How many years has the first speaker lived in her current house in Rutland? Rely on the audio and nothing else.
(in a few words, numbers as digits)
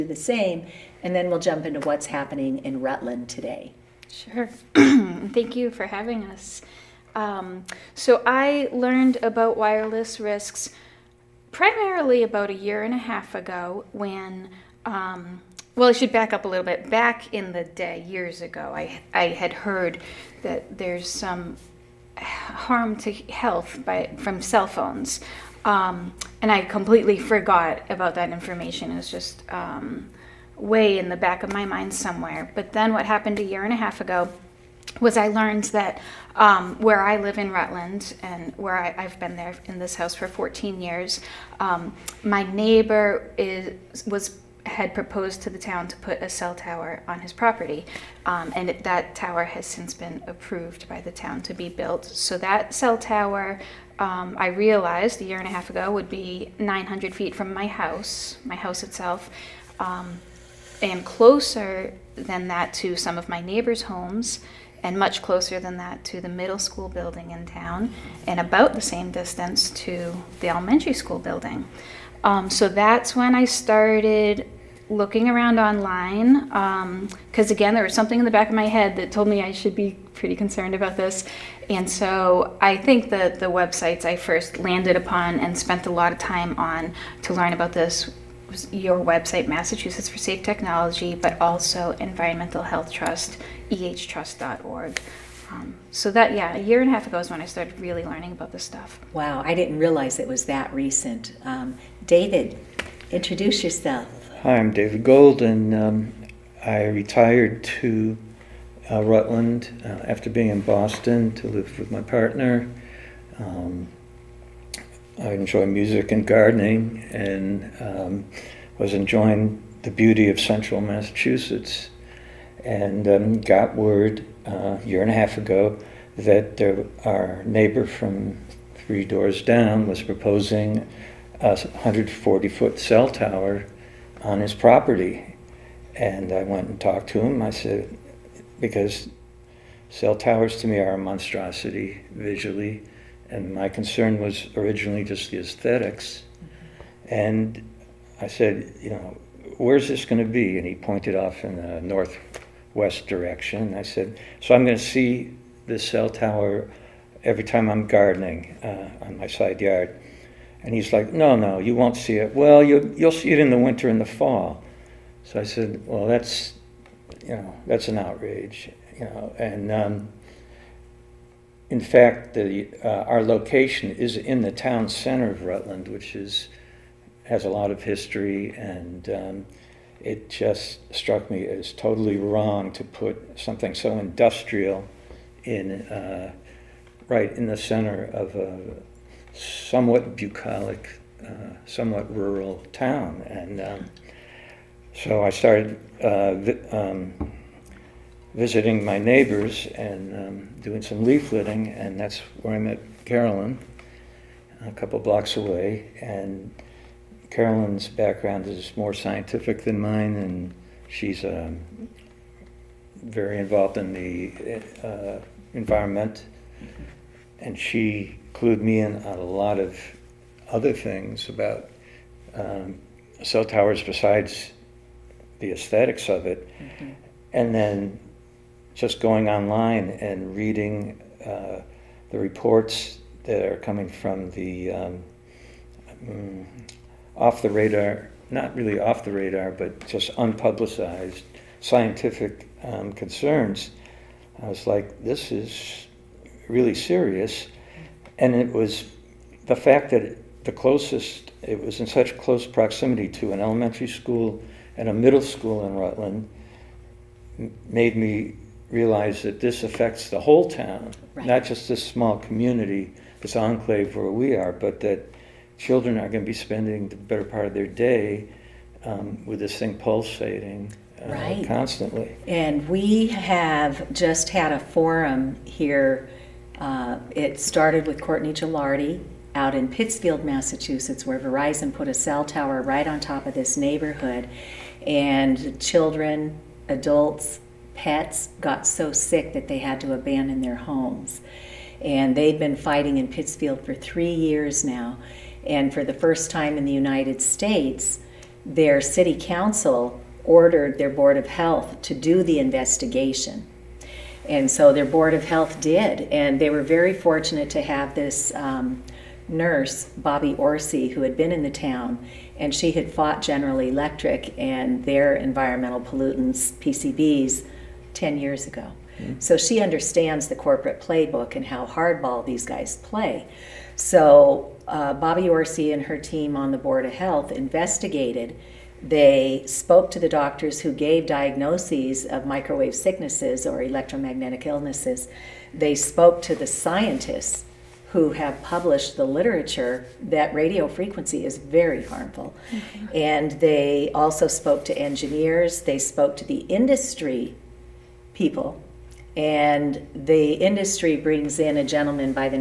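14.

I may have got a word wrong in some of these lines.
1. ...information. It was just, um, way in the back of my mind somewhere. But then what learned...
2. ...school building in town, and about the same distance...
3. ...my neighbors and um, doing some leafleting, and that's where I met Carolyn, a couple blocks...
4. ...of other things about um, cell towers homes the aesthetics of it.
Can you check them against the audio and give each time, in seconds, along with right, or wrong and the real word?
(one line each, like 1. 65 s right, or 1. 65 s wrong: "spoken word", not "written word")
1. 28 s wrong: "happened", not "learned"
2. 66 s right
3. 198 s right
4. 219 s wrong: "besides", not "homes".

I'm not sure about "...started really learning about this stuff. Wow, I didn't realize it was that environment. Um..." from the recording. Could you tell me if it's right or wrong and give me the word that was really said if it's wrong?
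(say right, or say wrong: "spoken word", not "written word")
wrong: "recent", not "environment".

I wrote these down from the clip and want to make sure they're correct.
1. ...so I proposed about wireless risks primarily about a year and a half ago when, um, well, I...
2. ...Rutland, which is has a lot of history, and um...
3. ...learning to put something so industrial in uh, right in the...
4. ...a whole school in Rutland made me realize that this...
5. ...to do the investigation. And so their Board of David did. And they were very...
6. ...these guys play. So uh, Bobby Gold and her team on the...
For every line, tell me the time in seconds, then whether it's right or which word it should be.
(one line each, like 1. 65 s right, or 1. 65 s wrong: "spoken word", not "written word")
1. 7 s wrong: "learned", not "proposed"
2. 175 s right
3. 182 s wrong: "wrong", not "learning"
4. 254 s wrong: "middle", not "whole"
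5. 301 s wrong: "Health", not "David"
6. 322 s wrong: "Orsi", not "Gold".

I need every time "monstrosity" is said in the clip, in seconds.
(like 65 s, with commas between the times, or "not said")
140 s.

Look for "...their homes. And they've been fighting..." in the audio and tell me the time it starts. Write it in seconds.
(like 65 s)
290 s.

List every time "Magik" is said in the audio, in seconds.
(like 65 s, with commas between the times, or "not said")
not said.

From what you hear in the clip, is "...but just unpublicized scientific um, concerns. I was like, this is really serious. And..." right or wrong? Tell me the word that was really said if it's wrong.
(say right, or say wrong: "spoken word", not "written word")
right.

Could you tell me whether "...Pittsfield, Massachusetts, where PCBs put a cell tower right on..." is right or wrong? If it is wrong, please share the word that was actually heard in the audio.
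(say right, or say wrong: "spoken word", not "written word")
wrong: "Verizon", not "PCBs".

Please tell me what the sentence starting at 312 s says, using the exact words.
And she had fought General Electric and their environmental pollutants, PCBs, 10 years ago.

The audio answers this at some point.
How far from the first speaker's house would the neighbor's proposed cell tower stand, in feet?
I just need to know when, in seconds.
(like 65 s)
56 s.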